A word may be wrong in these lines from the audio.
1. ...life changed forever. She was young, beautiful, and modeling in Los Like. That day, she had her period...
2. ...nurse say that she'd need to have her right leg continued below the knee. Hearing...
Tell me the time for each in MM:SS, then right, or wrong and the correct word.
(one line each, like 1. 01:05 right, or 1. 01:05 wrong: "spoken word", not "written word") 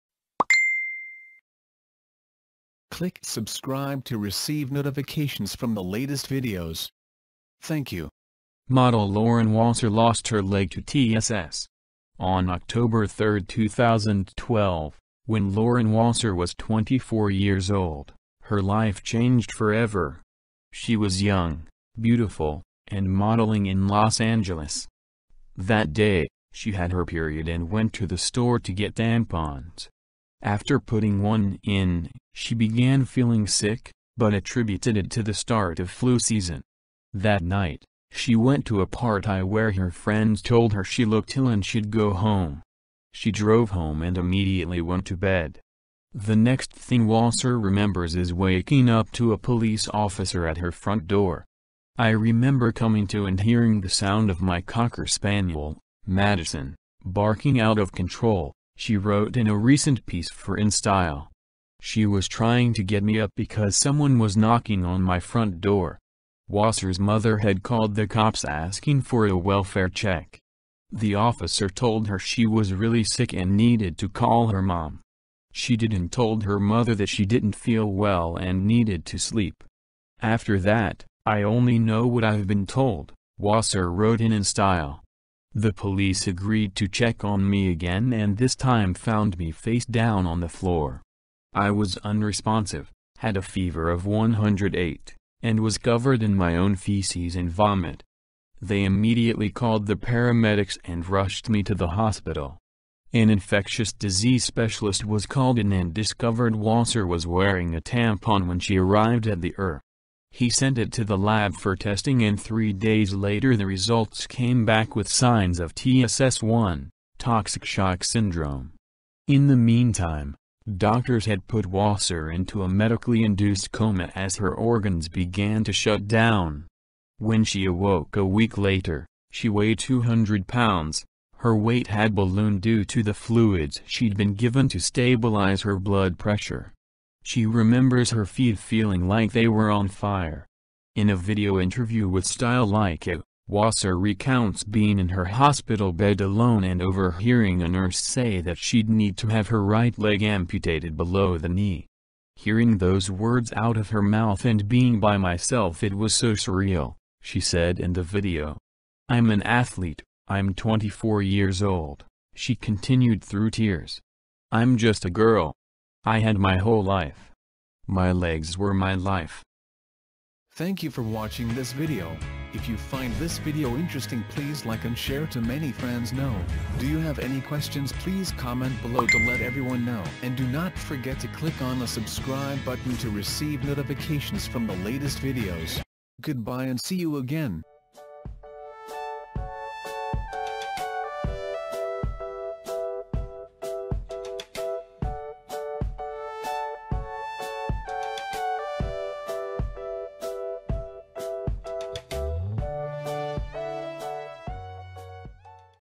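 1. 00:18 wrong: "Angeles", not "Like"
2. 02:27 wrong: "amputated", not "continued".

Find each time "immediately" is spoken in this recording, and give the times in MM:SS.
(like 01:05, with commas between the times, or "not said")
00:44, 01:38.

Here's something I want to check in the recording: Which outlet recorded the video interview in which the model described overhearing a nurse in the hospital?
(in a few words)
Style Like It.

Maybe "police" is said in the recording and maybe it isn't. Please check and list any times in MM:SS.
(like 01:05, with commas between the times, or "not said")
00:49, 01:25.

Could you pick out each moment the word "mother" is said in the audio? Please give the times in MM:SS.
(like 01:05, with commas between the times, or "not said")
01:06, 01:16.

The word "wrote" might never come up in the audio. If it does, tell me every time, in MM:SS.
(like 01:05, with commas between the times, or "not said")
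00:58, 01:23.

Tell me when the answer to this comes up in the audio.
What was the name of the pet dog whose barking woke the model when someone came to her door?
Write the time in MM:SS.
00:56.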